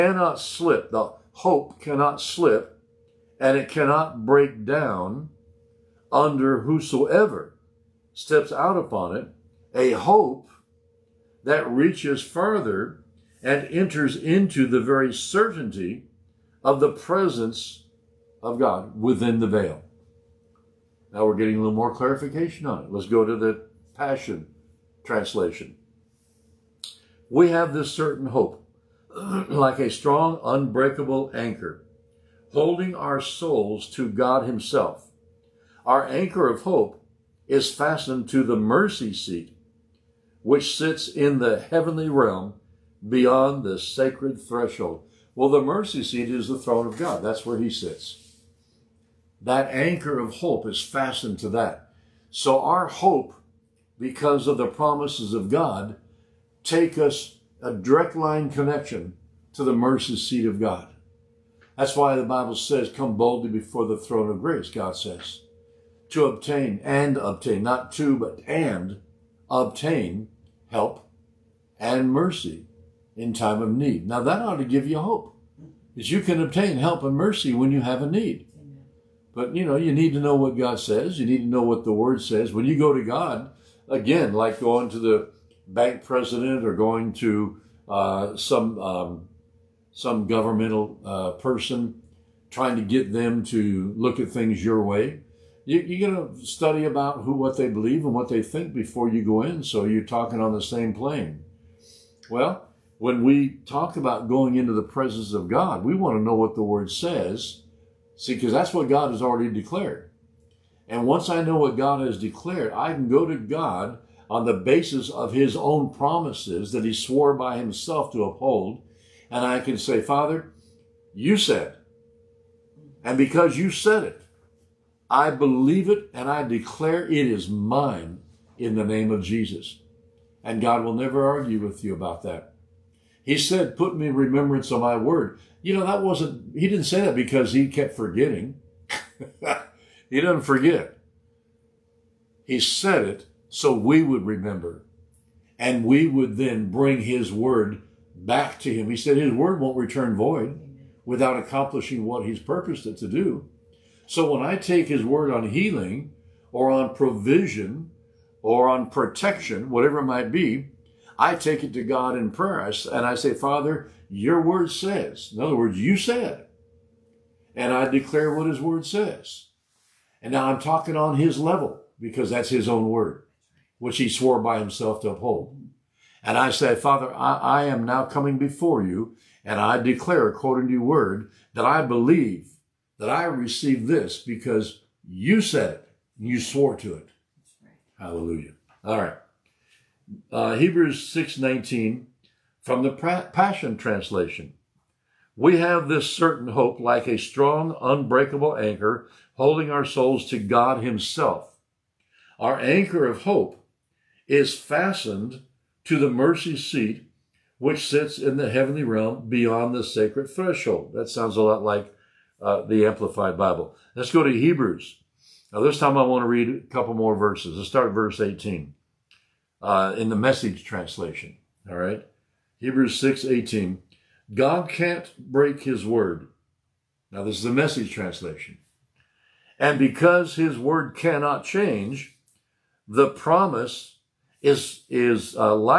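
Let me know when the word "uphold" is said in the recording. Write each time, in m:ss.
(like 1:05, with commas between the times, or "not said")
1:58, 2:55.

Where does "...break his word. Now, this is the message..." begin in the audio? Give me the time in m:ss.
3:45.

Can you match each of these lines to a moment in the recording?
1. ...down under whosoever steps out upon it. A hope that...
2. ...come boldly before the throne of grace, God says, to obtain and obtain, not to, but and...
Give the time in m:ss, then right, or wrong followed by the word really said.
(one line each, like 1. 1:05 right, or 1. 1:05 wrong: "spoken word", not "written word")
1. 0:04 right
2. 1:02 right.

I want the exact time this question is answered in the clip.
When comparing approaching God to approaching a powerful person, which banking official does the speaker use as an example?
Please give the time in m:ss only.
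1:25.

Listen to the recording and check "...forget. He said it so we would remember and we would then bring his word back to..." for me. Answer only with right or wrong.
right.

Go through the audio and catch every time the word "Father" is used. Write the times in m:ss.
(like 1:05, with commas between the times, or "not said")
2:00, 2:43, 2:56.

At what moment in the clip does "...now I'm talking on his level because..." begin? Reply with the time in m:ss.
2:50.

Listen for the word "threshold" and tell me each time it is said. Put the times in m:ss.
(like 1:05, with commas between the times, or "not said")
0:44, 3:30.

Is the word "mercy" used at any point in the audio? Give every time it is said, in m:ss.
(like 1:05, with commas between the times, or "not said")
0:38, 0:45, 0:59, 1:12, 1:17, 3:26.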